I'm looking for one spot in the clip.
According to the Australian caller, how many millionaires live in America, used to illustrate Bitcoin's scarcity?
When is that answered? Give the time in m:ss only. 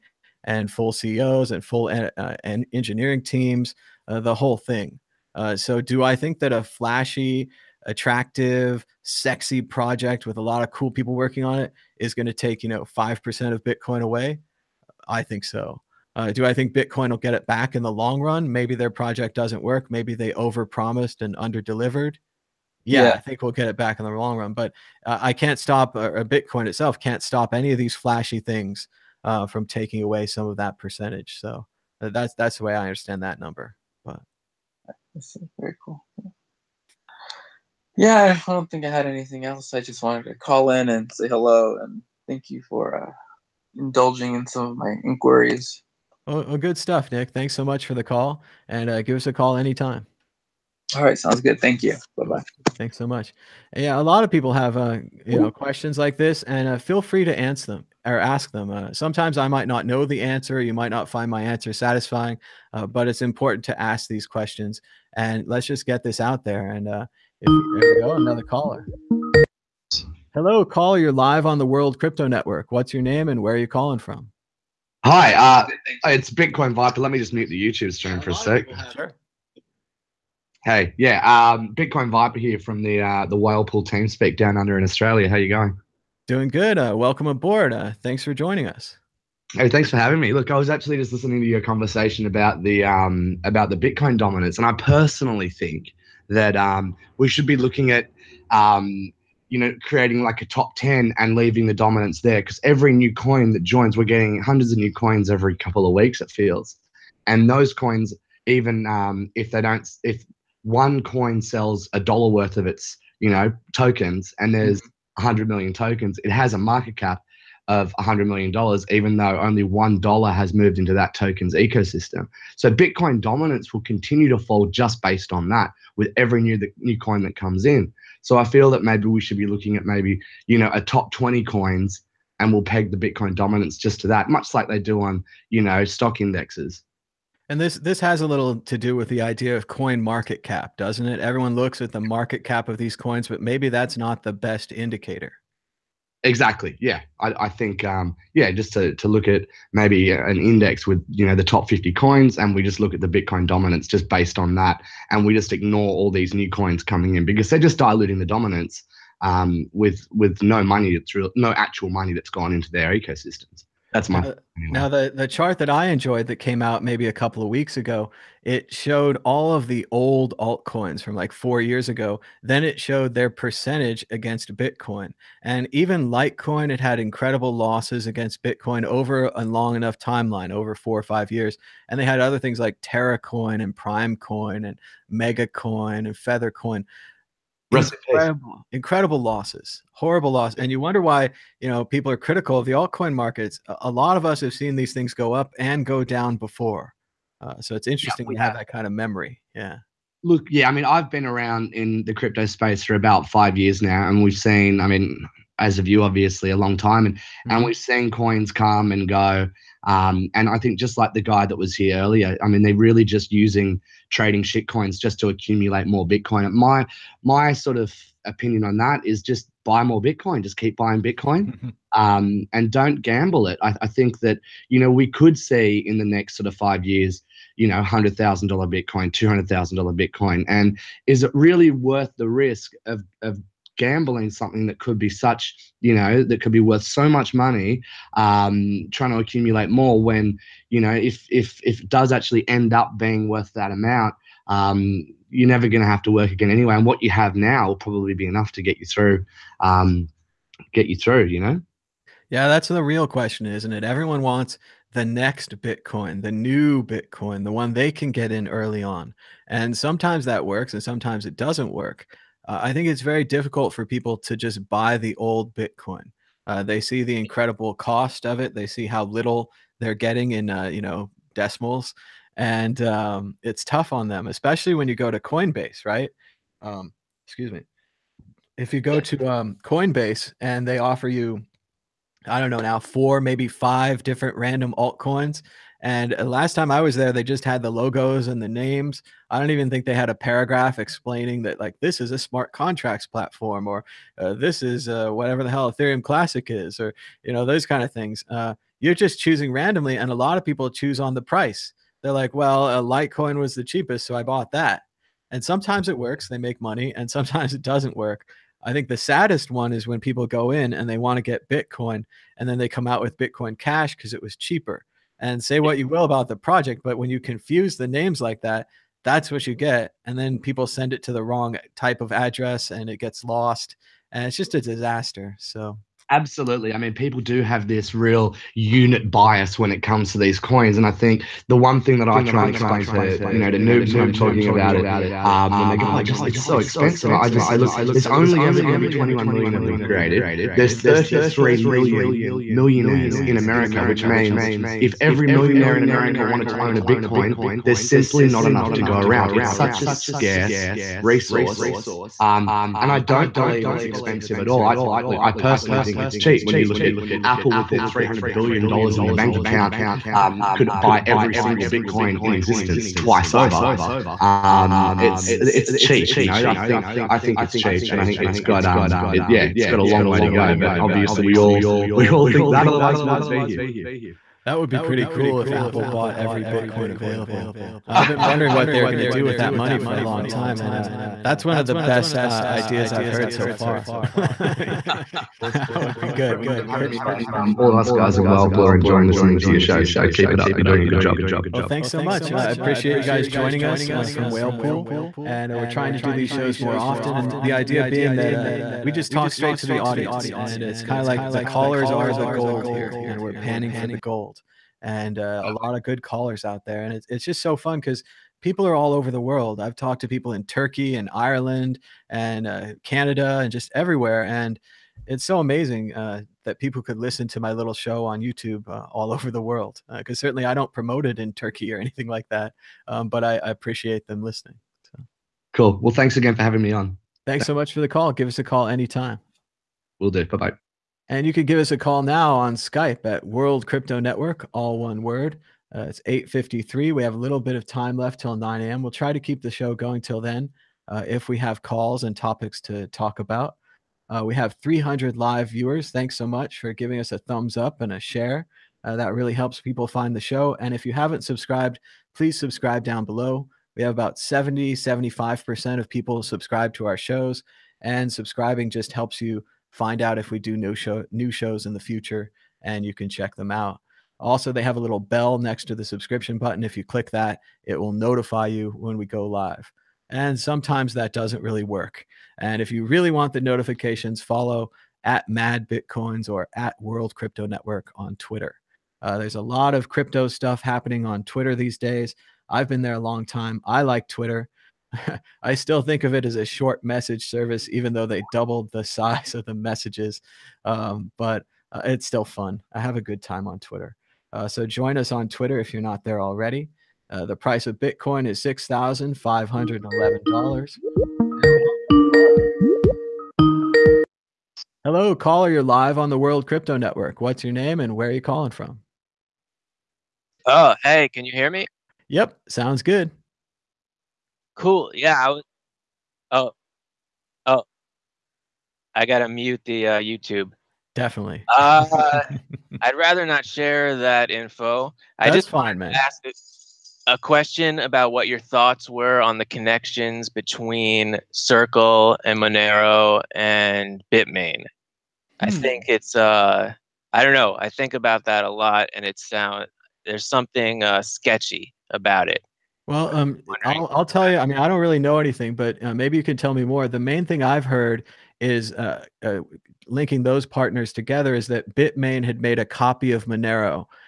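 5:40.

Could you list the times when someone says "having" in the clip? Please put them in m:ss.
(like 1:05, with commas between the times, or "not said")
1:29, 7:06.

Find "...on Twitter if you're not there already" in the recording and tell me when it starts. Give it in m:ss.
8:15.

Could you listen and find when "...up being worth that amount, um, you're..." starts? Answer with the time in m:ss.
4:02.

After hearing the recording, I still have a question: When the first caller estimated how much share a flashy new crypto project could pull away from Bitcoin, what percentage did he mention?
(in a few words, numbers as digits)
5%.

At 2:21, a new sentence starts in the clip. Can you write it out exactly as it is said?
Everyone looks at the market cap of these coins, but maybe that's not the best indicator.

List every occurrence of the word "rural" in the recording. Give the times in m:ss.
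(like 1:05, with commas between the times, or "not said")
not said.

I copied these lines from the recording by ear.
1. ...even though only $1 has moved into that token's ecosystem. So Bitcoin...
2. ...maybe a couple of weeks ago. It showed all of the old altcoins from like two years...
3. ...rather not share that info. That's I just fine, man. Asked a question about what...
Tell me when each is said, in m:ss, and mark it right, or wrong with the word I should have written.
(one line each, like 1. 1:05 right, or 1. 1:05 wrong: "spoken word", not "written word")
1. 1:58 right
2. 2:46 wrong: "four", not "two"
3. 8:42 right.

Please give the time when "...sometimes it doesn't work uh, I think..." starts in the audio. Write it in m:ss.
4:20.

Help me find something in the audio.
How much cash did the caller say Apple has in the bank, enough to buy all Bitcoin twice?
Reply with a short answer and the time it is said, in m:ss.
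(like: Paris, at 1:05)
$300 billion, at 5:57.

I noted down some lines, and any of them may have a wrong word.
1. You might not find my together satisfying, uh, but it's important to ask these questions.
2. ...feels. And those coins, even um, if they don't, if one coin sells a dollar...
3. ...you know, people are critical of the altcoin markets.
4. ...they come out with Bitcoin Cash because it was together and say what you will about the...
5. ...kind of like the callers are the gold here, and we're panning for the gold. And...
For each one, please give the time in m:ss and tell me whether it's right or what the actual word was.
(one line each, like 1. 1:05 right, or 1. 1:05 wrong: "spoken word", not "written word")
1. 1:00 wrong: "answer", not "together"
2. 1:46 right
3. 3:11 right
4. 5:12 wrong: "cheaper", not "together"
5. 6:40 right.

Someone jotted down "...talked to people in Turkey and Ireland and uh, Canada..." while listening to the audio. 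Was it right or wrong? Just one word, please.
right.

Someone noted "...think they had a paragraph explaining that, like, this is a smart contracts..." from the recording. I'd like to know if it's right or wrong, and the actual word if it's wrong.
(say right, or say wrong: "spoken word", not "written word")
right.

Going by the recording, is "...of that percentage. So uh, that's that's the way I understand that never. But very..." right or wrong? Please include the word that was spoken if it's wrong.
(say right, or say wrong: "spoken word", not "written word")
wrong: "number", not "never".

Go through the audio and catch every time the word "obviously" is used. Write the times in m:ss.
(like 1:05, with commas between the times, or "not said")
3:26, 6:10.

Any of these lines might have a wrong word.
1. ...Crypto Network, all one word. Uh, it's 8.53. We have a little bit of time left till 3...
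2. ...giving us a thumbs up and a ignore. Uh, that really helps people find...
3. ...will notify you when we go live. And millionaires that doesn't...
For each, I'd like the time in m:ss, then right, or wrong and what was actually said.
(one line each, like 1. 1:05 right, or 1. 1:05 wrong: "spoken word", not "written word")
1. 7:13 wrong: "9", not "3"
2. 7:26 wrong: "share", not "ignore"
3. 7:47 wrong: "sometimes", not "millionaires".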